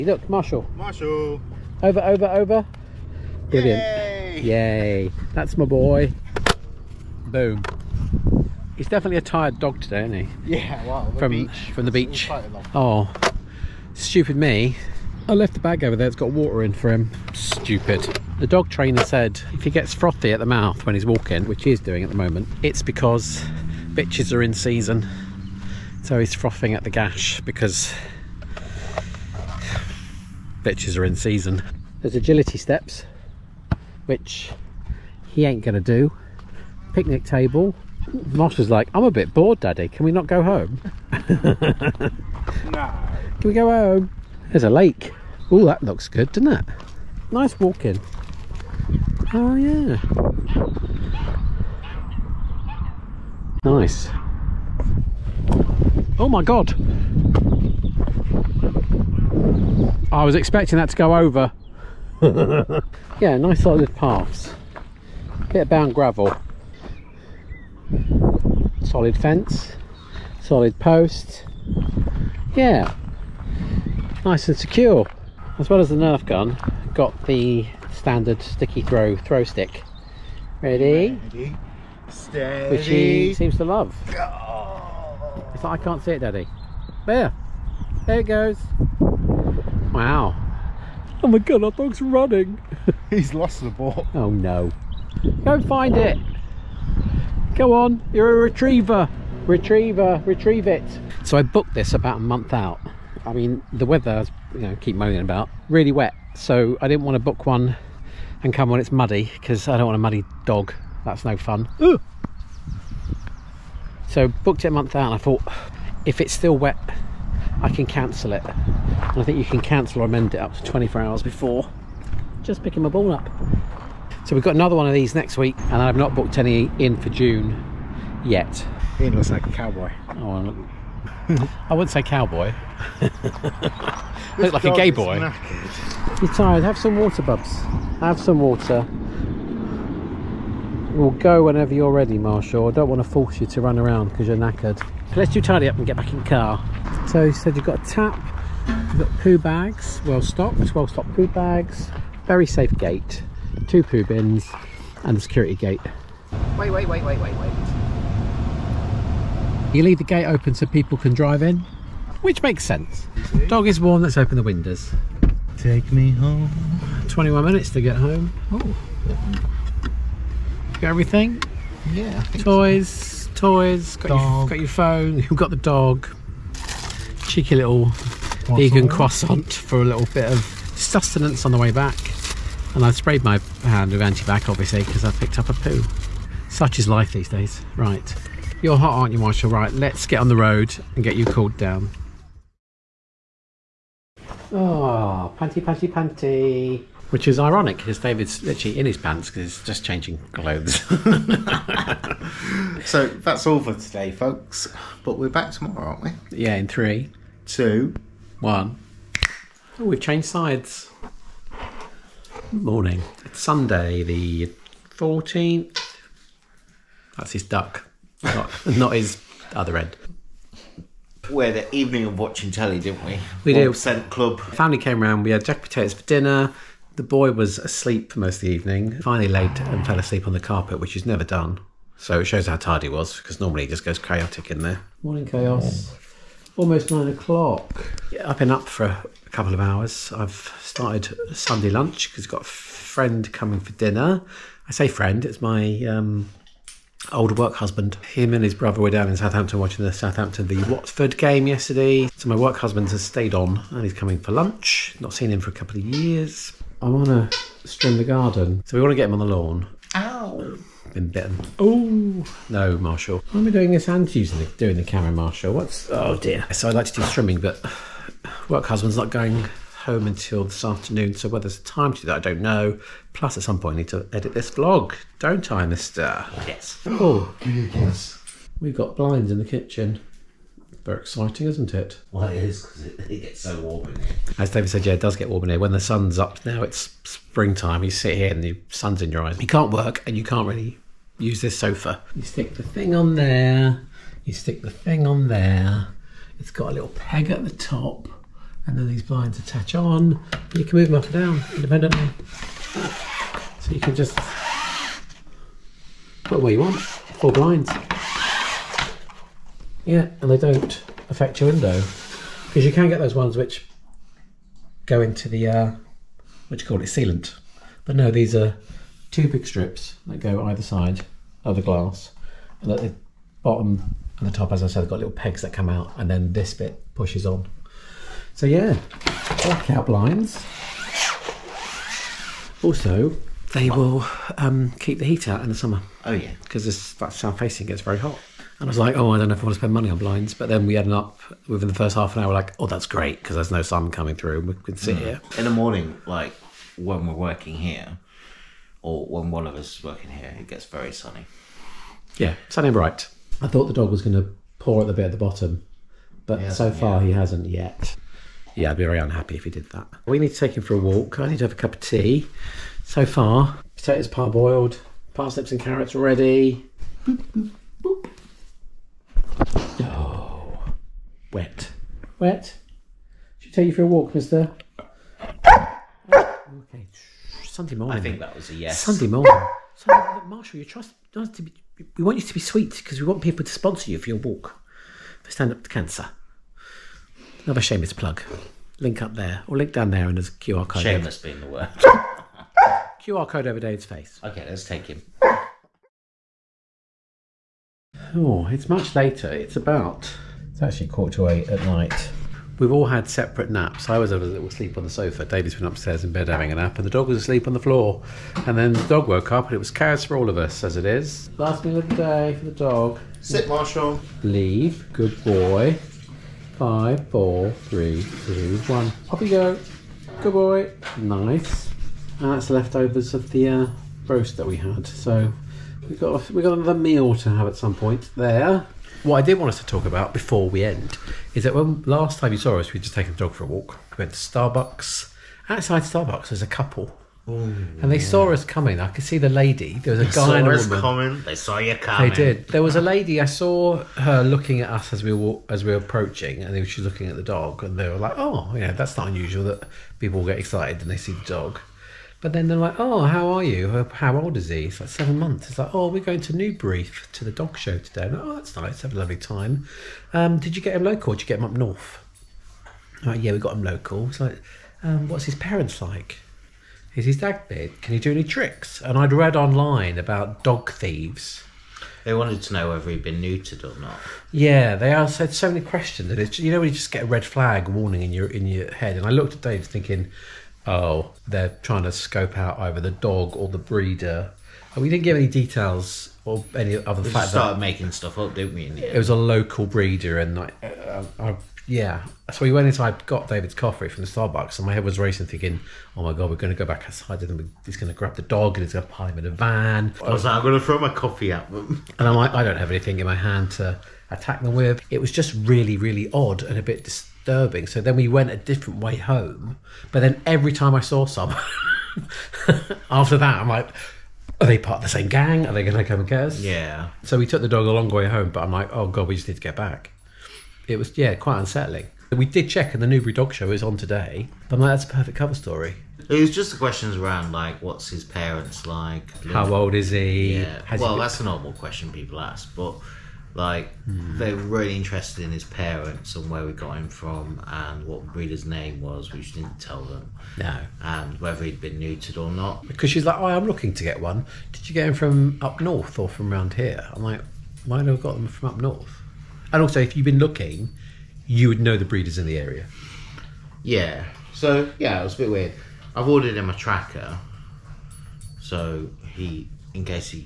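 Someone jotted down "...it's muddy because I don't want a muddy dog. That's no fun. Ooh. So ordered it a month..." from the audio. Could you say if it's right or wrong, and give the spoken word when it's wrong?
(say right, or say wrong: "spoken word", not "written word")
wrong: "booked", not "ordered".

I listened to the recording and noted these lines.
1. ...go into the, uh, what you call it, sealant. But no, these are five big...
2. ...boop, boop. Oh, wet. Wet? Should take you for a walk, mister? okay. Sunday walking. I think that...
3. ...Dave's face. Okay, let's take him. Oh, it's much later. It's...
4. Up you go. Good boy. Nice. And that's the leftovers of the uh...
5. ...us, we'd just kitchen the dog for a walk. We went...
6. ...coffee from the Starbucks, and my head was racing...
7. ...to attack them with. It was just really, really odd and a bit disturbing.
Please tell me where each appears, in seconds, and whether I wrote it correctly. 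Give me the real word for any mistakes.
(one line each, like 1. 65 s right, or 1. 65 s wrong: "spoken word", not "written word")
1. 314 s wrong: "two", not "five"
2. 367 s wrong: "morning", not "walking"
3. 393 s right
4. 419 s right
5. 432 s wrong: "taken", not "kitchen"
6. 493 s right
7. 503 s right.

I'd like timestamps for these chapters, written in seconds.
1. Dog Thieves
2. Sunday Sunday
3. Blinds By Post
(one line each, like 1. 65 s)
1. 397 s
2. 208 s
3. 266 s.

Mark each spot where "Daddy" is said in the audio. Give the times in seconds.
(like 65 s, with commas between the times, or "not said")
39 s, 86 s.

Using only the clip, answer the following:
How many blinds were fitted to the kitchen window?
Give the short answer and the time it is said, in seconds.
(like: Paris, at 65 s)
4, at 306 s.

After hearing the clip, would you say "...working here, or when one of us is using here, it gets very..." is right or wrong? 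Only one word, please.
wrong.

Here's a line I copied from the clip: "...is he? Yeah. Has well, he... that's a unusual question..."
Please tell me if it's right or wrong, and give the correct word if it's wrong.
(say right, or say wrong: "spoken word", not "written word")
wrong: "normal", not "unusual".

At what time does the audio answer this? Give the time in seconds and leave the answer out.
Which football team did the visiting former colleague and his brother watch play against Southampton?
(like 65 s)
250 s.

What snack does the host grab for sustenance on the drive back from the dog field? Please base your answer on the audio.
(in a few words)
Vegan croissant.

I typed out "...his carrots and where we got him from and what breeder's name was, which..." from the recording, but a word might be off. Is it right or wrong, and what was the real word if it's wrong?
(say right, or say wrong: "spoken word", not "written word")
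wrong: "parents", not "carrots".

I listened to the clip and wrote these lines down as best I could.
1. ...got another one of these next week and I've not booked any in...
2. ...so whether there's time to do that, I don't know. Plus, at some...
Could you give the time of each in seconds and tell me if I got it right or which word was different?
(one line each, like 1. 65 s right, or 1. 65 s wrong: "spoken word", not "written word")
1. 124 s right
2. 271 s right.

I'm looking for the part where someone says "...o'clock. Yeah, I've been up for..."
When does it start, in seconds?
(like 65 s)
237 s.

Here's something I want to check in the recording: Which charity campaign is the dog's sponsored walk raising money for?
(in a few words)
Stand Up to Cancer.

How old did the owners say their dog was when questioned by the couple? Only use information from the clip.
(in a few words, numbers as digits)
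7 months.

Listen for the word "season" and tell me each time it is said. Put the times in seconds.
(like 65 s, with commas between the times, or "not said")
24 s, 31 s.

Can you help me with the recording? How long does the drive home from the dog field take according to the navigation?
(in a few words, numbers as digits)
21 minutes.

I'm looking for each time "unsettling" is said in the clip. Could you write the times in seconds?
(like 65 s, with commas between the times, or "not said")
521 s.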